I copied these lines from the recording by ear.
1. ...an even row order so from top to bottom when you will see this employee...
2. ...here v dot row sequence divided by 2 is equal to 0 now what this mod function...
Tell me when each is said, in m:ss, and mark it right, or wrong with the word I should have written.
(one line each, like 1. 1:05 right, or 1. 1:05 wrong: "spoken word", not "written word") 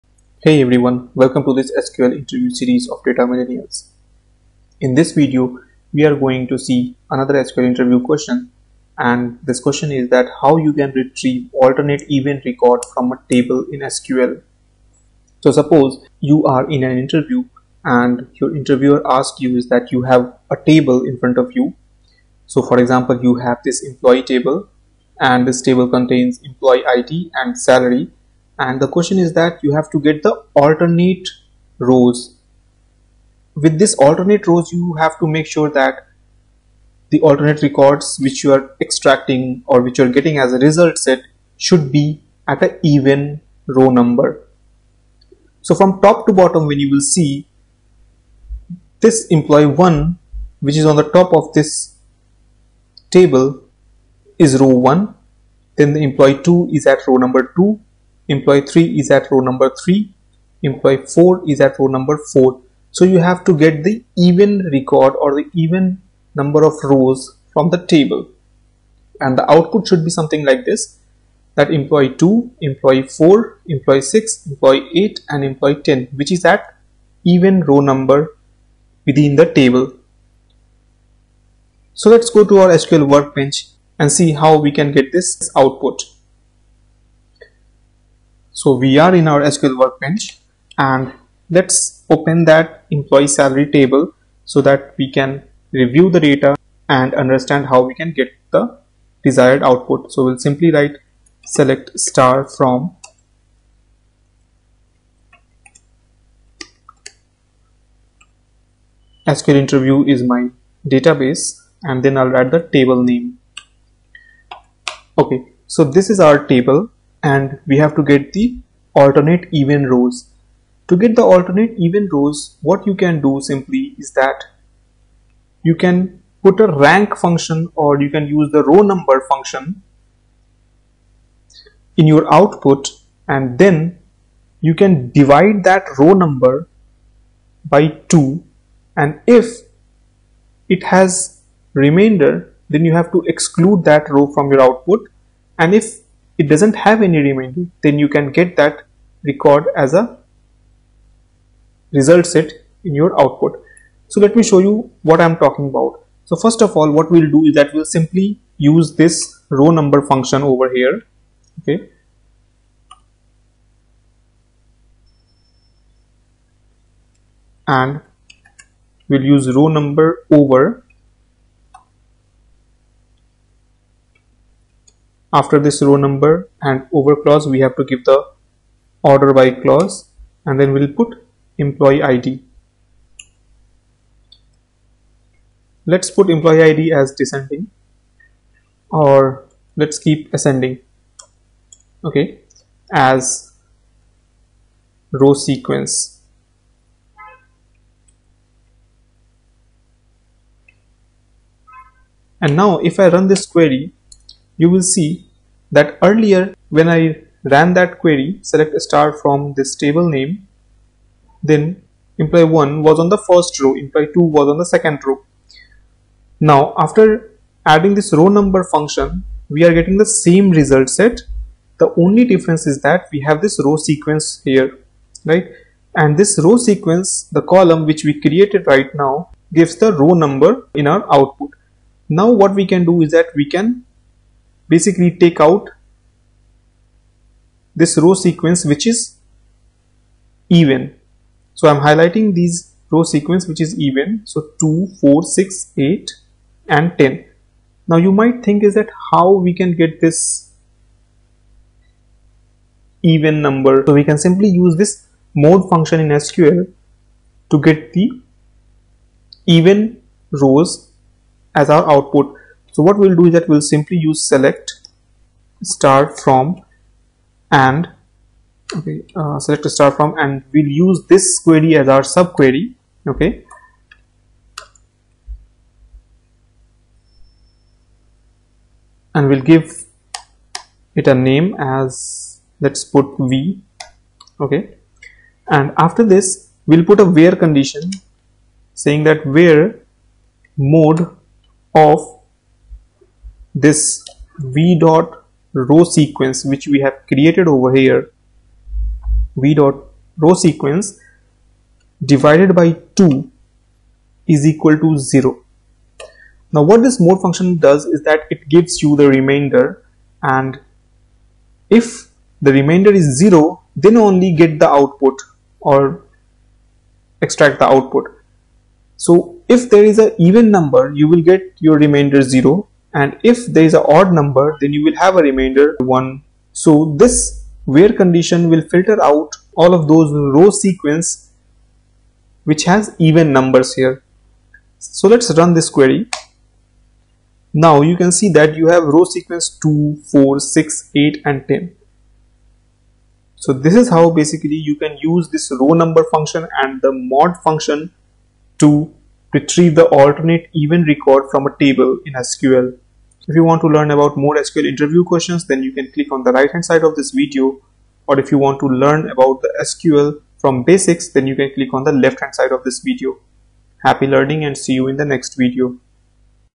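1. 0:42 wrong: "number", not "order"
2. 4:57 right.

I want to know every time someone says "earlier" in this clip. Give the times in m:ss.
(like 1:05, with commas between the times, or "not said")
3:26.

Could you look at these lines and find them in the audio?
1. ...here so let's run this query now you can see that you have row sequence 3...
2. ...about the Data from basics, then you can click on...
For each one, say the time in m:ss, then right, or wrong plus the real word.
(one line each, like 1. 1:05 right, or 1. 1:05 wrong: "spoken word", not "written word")
1. 5:33 wrong: "2", not "3"
2. 5:59 wrong: "SQL", not "Data".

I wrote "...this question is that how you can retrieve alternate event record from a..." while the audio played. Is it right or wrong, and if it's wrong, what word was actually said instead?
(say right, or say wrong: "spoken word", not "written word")
right.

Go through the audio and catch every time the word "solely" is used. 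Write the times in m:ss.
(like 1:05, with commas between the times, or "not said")
not said.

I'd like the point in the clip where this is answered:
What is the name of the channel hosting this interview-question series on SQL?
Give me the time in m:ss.
0:03.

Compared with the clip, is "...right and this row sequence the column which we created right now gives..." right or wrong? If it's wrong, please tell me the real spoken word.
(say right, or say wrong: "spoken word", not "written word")
right.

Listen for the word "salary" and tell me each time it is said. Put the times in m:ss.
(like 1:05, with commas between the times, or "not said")
0:27, 1:33.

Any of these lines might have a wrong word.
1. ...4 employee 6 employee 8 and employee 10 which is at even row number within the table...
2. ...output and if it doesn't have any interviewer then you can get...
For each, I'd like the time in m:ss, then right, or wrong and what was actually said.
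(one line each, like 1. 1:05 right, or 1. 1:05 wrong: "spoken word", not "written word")
1. 1:13 right
2. 2:24 wrong: "remainder", not "interviewer".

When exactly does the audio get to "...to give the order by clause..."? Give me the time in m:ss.
2:57.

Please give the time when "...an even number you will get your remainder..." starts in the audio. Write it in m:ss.
5:19.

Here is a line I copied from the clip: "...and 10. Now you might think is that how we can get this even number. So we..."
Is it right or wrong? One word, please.
right.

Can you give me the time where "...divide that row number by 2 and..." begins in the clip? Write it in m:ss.
2:15.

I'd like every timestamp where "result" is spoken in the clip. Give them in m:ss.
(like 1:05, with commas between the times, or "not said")
0:40, 2:31, 3:40.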